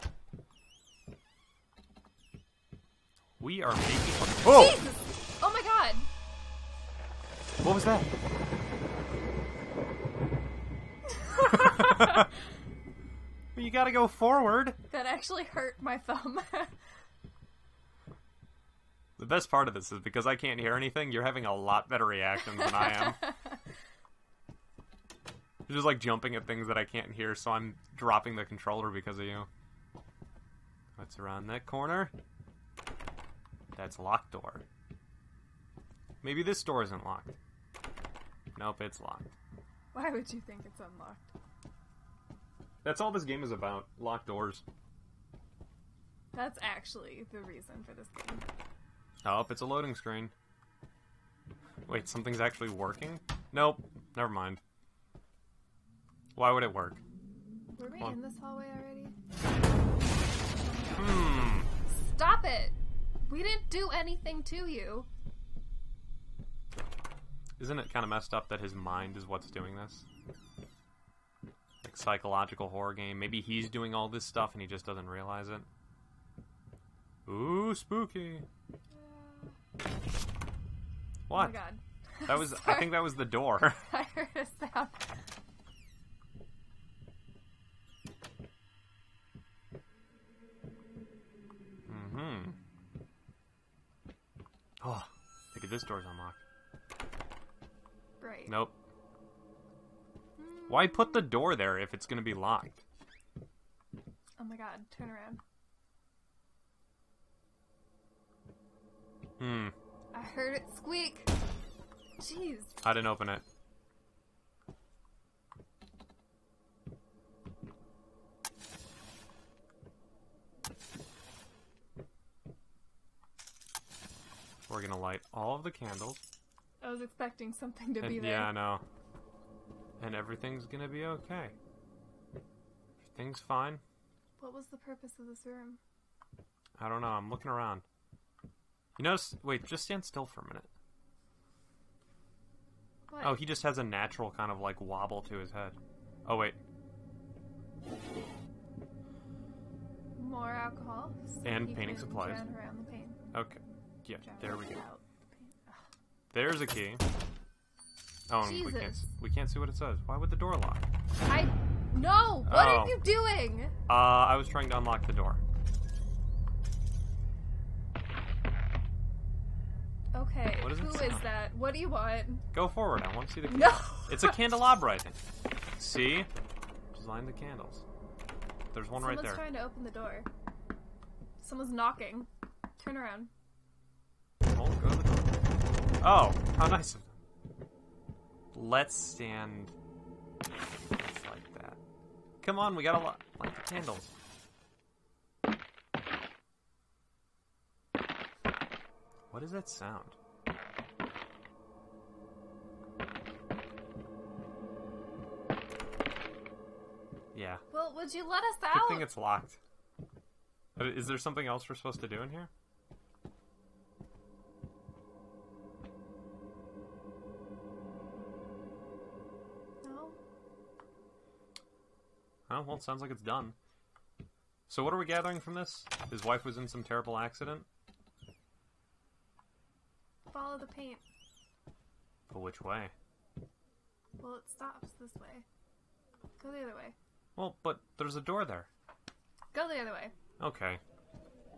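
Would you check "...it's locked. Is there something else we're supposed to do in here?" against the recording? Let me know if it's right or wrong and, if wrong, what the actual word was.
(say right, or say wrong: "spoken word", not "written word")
right.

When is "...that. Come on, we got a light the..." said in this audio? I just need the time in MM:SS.
03:11.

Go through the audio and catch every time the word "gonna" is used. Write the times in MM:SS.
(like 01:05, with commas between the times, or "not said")
01:42, 02:04, 02:10.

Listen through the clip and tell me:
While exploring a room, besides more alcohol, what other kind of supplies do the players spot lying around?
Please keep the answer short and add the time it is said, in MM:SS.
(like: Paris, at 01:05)
painting supplies, at 02:31.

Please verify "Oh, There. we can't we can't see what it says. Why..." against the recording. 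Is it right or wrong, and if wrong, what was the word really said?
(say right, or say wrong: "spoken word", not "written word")
wrong: "Jesus", not "There".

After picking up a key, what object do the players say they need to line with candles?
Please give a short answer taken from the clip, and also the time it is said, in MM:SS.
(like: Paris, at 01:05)
candelabra, at 02:54.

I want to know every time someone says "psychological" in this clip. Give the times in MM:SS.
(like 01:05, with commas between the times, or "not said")
01:12.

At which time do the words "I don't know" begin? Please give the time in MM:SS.
02:16.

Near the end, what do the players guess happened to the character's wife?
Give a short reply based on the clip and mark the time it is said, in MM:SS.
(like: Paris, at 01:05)
terrible accident, at 03:46.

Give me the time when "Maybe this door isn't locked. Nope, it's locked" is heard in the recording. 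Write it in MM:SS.
00:36.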